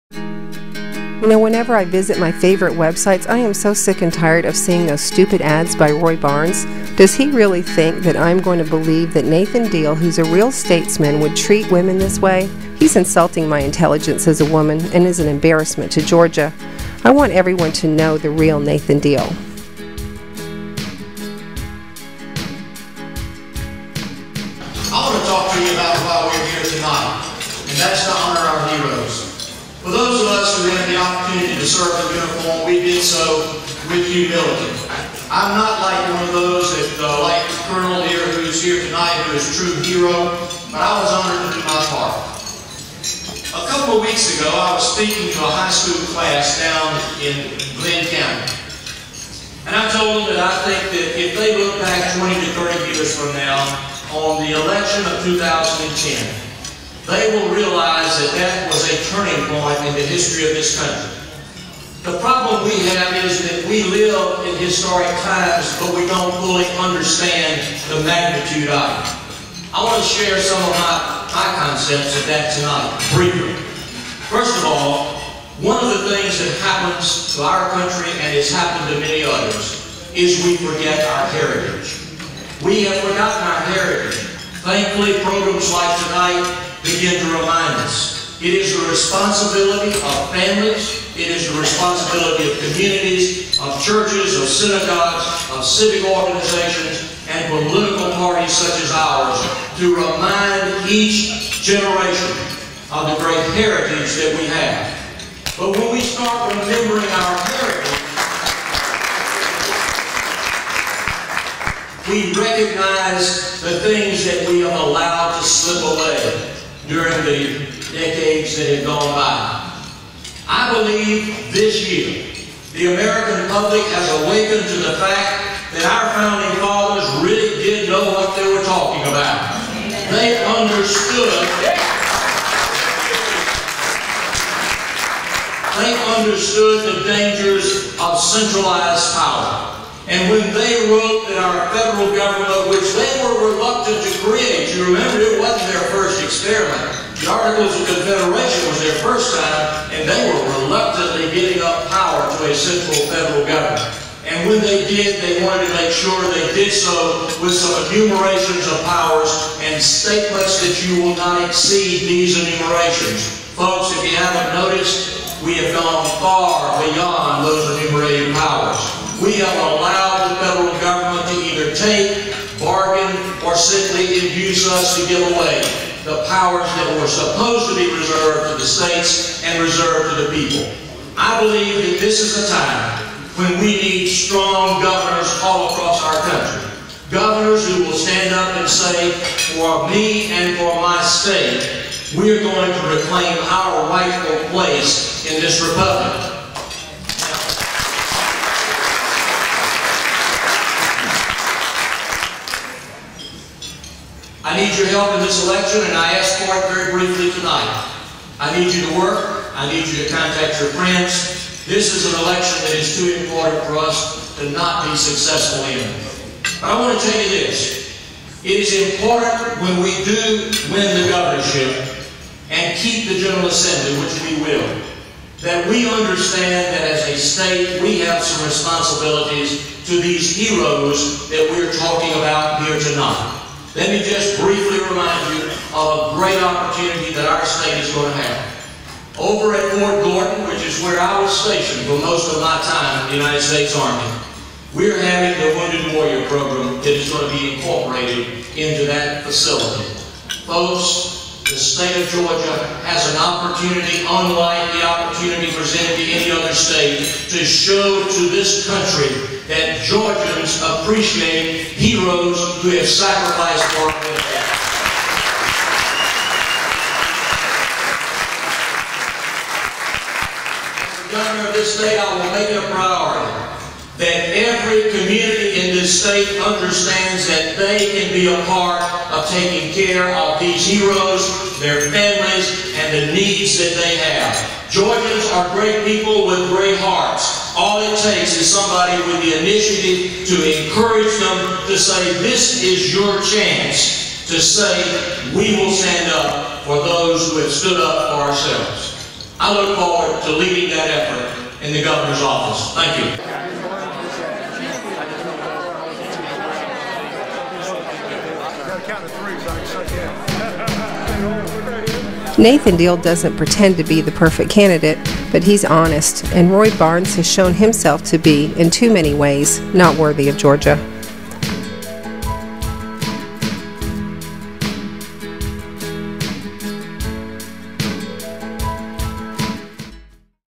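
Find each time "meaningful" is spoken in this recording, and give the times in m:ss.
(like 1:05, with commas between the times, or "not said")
not said.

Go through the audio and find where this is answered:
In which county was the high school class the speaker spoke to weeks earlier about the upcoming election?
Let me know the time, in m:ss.
0:47.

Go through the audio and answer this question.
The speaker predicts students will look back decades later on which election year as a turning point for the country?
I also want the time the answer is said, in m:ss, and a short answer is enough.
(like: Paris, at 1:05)
2010, at 0:55.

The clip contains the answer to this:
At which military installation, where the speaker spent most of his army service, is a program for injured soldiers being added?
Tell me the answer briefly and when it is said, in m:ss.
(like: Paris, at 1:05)
Fort Gordon, at 3:59.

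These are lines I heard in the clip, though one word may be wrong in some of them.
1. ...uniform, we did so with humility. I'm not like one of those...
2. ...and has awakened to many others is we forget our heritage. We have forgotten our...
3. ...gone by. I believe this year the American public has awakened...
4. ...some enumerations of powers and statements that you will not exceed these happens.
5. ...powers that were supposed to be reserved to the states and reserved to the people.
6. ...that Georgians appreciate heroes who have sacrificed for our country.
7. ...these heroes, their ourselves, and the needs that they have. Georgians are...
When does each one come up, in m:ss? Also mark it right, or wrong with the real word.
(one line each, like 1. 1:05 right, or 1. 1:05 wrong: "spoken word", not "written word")
1. 0:32 right
2. 1:18 wrong: "happened", not "awakened"
3. 1:58 right
4. 2:37 wrong: "enumerations", not "happens"
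5. 2:56 right
6. 4:19 right
7. 4:40 wrong: "families", not "ourselves".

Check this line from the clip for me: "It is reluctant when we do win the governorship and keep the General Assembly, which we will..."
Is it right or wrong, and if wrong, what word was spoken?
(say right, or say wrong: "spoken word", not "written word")
wrong: "important", not "reluctant".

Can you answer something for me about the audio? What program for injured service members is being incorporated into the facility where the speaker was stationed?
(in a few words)
Wounded Warrior.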